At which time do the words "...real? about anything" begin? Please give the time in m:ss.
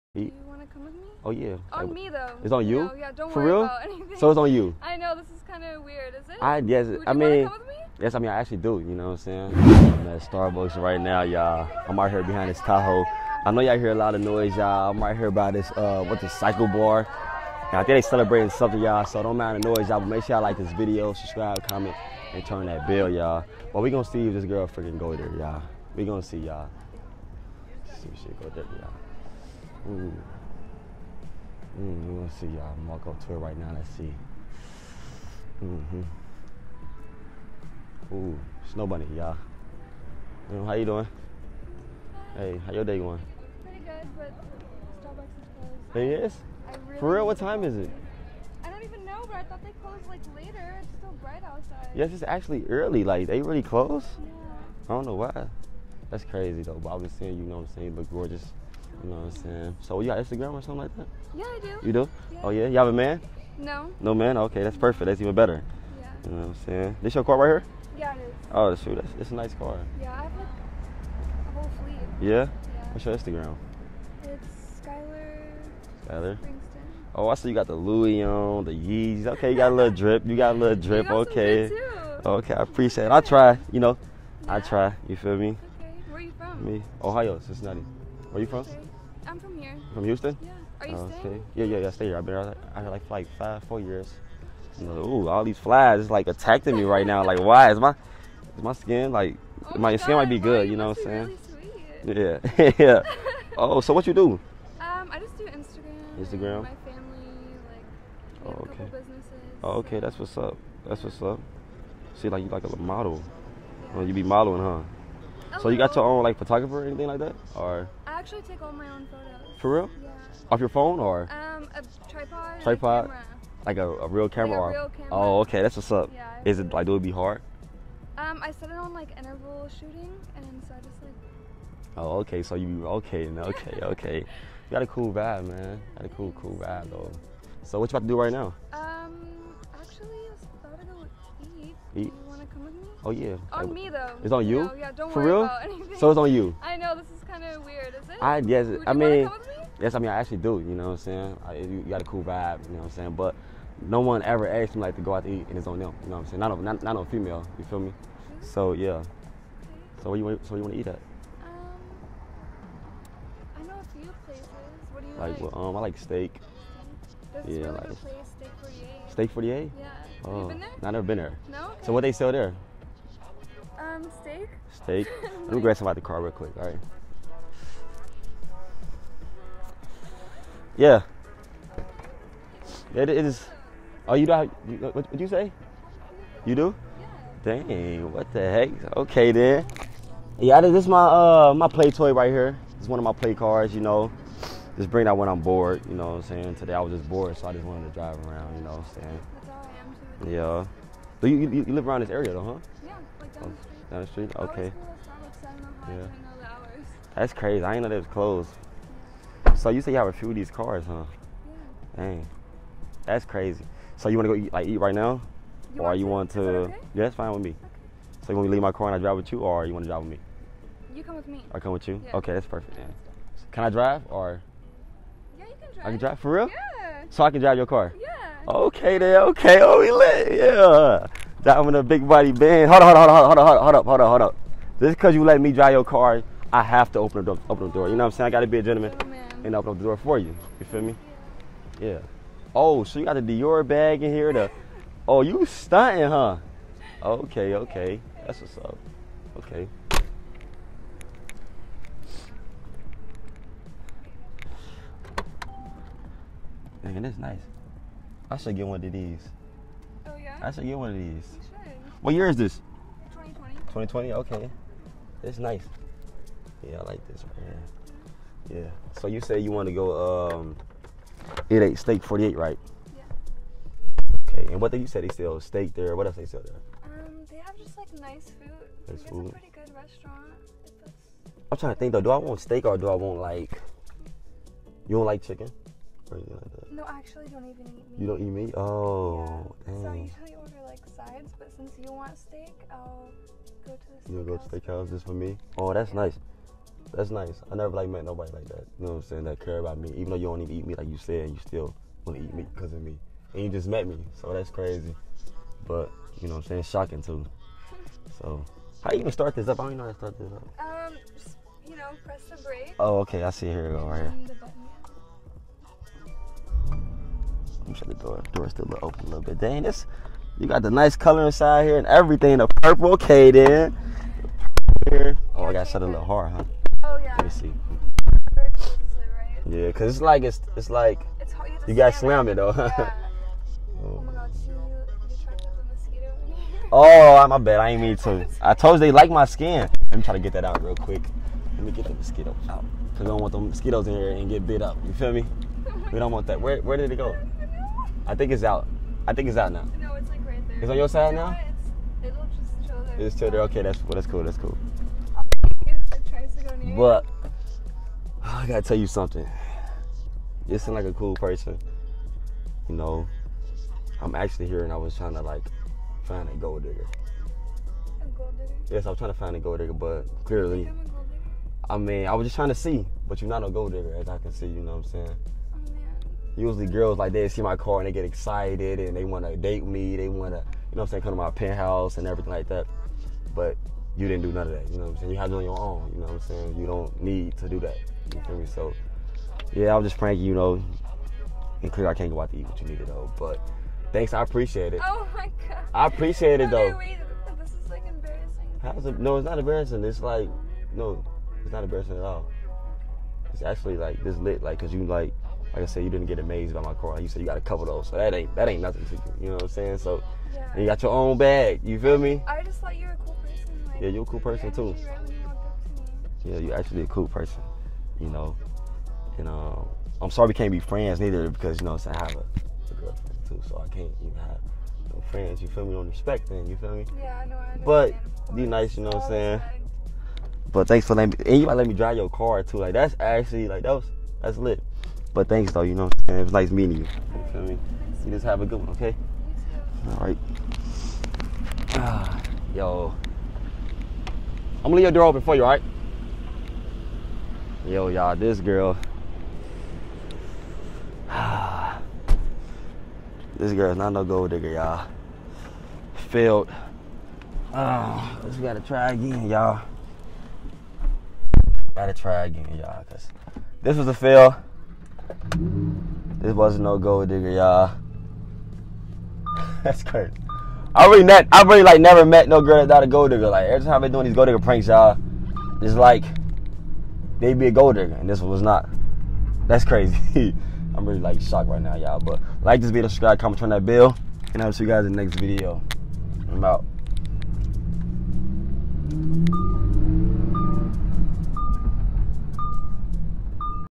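0:03.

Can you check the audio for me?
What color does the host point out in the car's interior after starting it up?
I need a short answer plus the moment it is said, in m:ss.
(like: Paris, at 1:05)
purple, at 5:22.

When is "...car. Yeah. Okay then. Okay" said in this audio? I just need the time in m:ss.
3:47.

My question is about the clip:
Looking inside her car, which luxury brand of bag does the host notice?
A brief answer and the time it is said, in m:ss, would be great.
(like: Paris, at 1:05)
Dior, at 4:03.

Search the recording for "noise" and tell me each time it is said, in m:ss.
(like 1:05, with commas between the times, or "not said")
0:14, 0:19.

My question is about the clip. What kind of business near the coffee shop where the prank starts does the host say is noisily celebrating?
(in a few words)
cycle bar.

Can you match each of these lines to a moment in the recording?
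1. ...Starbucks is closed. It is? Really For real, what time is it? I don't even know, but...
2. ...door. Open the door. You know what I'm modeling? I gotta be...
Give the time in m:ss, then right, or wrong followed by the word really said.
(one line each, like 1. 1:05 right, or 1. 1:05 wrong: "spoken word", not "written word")
1. 0:45 right
2. 3:57 wrong: "saying", not "modeling".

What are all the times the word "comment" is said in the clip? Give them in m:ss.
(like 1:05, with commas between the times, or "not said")
0:21, 8:03.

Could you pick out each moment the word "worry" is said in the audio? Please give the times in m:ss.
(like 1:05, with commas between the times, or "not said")
0:03, 2:25.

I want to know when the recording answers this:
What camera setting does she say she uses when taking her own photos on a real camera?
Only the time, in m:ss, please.
2:09.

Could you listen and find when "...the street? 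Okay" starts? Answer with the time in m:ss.
3:24.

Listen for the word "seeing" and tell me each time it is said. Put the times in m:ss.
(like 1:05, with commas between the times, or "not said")
0:57.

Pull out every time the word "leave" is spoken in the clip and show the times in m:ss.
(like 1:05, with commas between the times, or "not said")
3:38, 7:24.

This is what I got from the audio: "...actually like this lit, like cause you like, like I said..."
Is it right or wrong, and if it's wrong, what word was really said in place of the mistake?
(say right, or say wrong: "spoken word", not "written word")
right.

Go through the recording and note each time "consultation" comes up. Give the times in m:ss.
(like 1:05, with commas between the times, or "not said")
not said.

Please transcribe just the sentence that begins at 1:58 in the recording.
actually take all my own photos.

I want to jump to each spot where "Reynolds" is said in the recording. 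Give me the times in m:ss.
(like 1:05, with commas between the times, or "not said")
not said.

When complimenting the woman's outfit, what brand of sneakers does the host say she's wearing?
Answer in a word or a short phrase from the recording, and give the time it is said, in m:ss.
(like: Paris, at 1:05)
Yeezys, at 1:18.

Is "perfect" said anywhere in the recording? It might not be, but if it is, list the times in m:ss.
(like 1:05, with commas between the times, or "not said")
1:04, 3:42.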